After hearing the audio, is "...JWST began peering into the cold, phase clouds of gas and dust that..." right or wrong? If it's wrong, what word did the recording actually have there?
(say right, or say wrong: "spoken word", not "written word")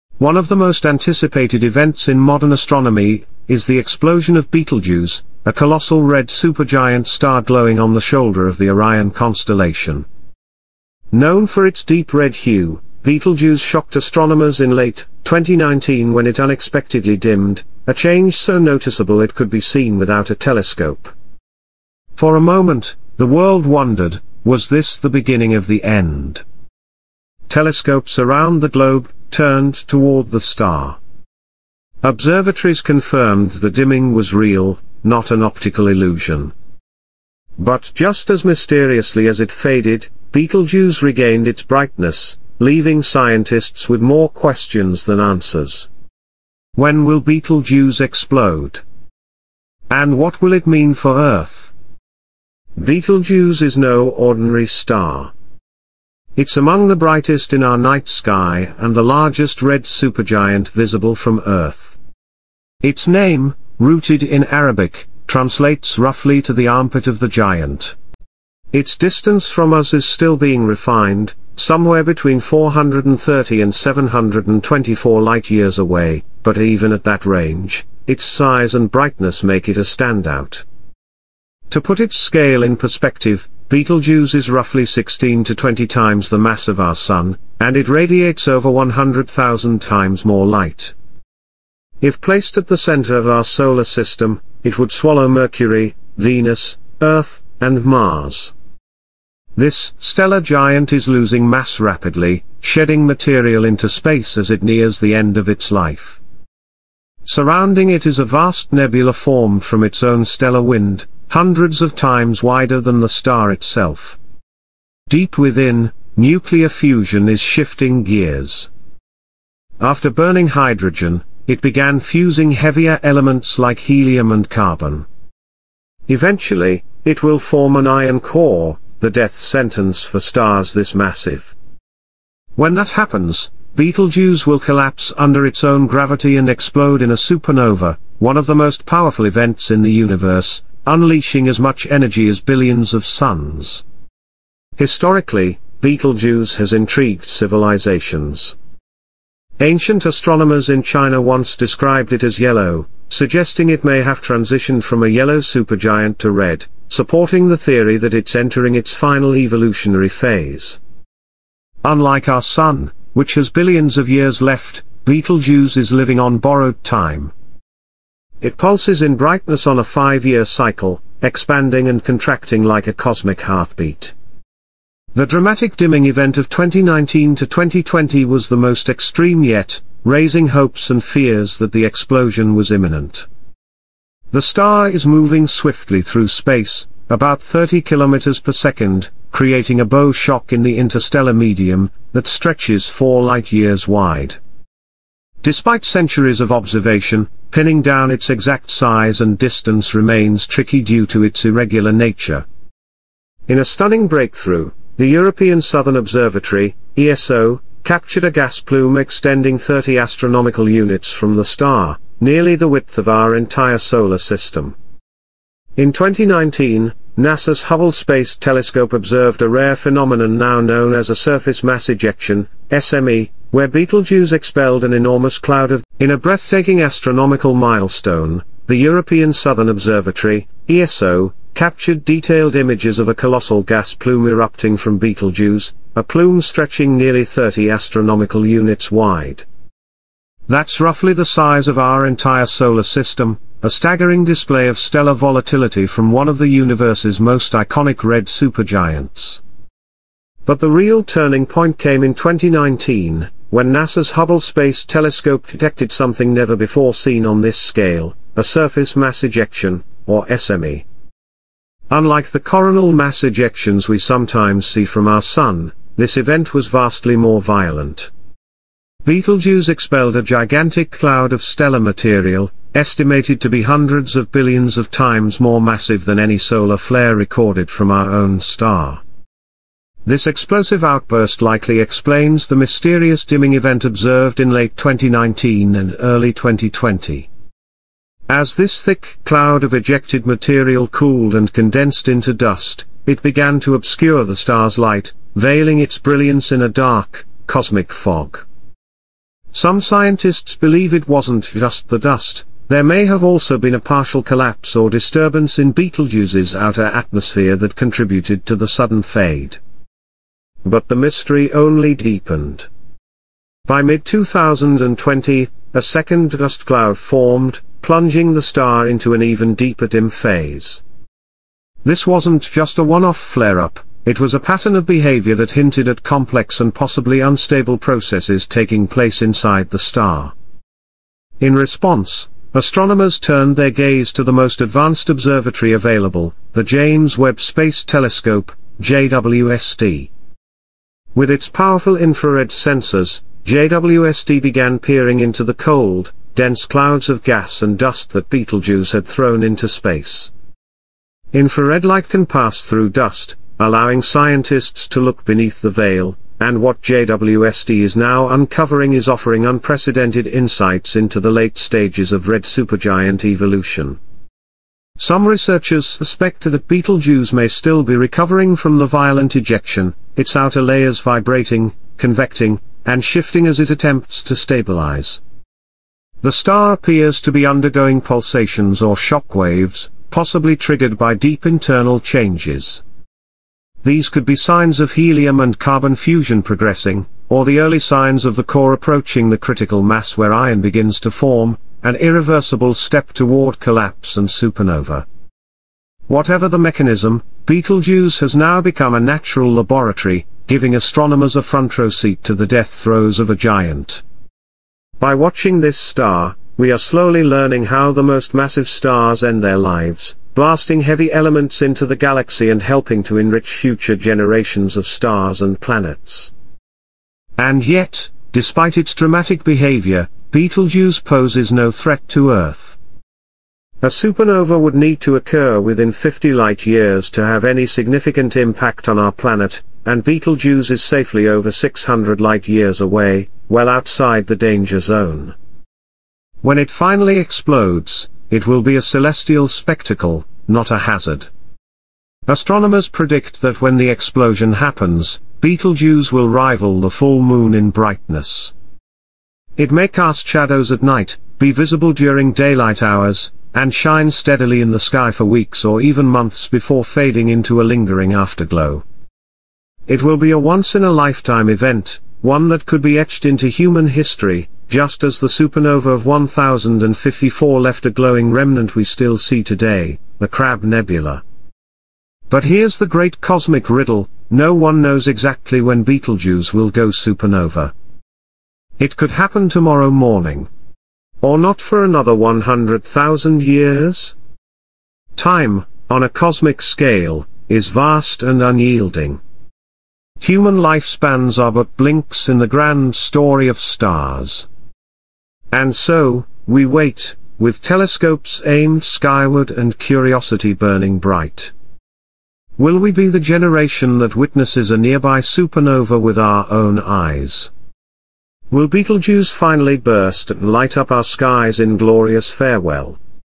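wrong: "dense", not "phase".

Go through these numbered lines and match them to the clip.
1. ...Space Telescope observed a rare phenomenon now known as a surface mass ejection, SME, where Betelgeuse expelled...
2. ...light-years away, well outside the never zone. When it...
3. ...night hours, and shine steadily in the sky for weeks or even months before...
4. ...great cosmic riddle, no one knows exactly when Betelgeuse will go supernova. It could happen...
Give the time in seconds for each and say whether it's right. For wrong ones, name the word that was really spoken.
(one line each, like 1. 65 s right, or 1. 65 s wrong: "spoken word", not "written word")
1. 217 s right
2. 432 s wrong: "danger", not "never"
3. 452 s wrong: "daylight", not "night"
4. 472 s right.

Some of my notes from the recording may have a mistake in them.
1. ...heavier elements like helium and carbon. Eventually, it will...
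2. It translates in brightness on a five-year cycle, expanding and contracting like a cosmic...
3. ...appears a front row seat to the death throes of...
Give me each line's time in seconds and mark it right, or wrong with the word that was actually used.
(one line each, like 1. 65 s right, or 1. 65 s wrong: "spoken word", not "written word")
1. 122 s right
2. 168 s wrong: "pulses", not "translates"
3. 400 s wrong: "astronomers", not "appears".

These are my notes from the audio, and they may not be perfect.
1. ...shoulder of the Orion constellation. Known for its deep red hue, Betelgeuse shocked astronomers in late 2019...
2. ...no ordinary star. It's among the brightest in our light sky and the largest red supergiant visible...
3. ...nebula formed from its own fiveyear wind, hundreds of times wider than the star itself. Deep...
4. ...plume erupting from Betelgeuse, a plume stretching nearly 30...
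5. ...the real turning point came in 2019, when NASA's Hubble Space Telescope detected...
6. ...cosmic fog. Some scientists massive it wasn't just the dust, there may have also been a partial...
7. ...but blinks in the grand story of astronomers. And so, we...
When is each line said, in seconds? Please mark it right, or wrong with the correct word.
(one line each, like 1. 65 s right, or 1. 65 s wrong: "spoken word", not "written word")
1. 8 s right
2. 53 s wrong: "night", not "light"
3. 108 s wrong: "stellar", not "fiveyear"
4. 233 s right
5. 250 s right
6. 297 s wrong: "believe", not "massive"
7. 491 s wrong: "stars", not "astronomers".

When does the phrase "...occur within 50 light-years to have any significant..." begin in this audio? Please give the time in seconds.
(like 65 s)
425 s.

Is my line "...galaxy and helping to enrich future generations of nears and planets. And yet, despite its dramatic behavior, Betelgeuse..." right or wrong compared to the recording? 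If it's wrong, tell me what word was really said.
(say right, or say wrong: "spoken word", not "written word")
wrong: "stars", not "nears".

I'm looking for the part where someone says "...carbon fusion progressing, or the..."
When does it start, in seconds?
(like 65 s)
385 s.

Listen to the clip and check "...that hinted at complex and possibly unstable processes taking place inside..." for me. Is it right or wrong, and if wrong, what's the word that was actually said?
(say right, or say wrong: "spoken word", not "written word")
right.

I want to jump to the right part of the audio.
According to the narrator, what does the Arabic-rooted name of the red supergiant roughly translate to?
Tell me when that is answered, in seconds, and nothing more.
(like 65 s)
66 s.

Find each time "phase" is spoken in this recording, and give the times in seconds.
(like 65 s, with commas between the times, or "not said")
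160 s, 320 s.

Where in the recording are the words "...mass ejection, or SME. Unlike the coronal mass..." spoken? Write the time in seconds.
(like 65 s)
258 s.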